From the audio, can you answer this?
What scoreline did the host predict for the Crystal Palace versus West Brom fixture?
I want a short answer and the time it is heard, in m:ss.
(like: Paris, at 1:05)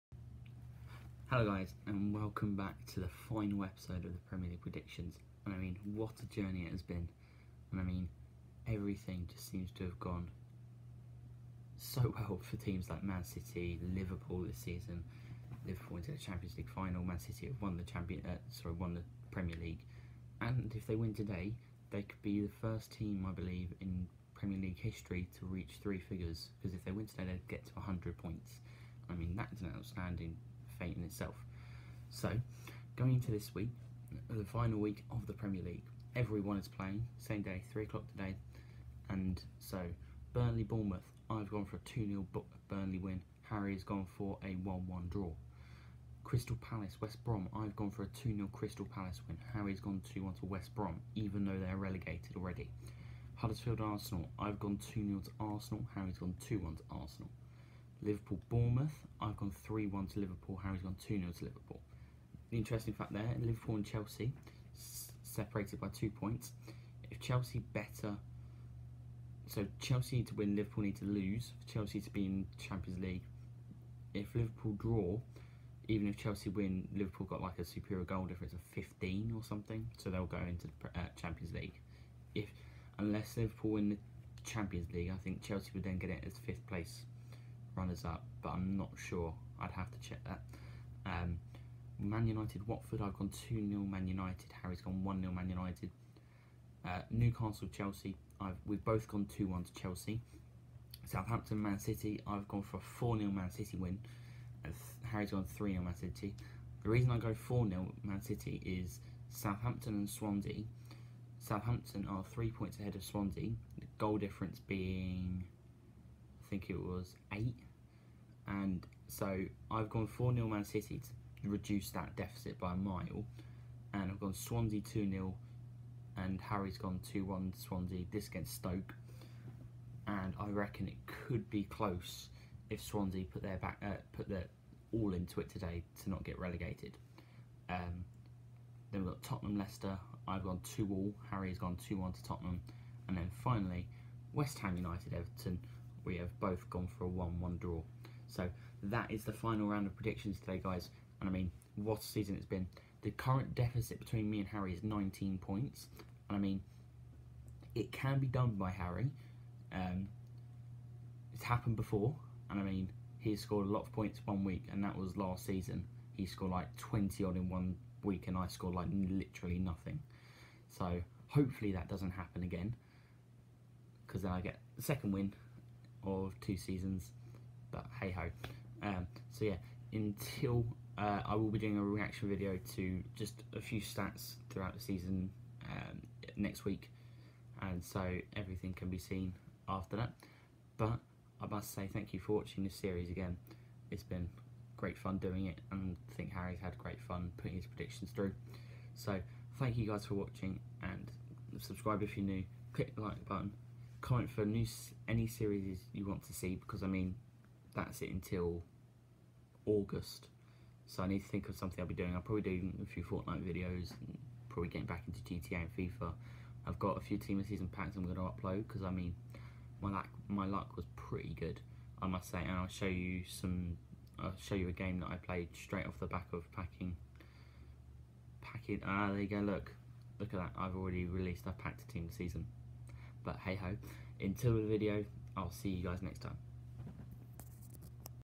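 2-0 Crystal Palace, at 0:48.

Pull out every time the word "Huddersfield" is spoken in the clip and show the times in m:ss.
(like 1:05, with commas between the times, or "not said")
0:53.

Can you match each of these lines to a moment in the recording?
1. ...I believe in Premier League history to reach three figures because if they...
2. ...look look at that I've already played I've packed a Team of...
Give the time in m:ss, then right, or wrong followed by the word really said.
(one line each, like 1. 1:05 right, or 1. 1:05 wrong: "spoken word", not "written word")
1. 0:23 right
2. 3:49 wrong: "released", not "played".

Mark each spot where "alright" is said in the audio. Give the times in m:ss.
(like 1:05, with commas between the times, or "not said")
not said.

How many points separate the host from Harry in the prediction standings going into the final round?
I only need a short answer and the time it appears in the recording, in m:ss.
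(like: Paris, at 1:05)
19, at 2:34.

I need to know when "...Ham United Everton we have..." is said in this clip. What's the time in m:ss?
2:24.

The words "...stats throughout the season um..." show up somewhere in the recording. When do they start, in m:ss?
3:03.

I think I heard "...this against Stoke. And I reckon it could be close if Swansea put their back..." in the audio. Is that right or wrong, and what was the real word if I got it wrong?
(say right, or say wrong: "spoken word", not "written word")
right.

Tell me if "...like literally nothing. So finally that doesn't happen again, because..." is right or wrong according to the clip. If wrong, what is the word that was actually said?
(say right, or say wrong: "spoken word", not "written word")
wrong: "hopefully", not "finally".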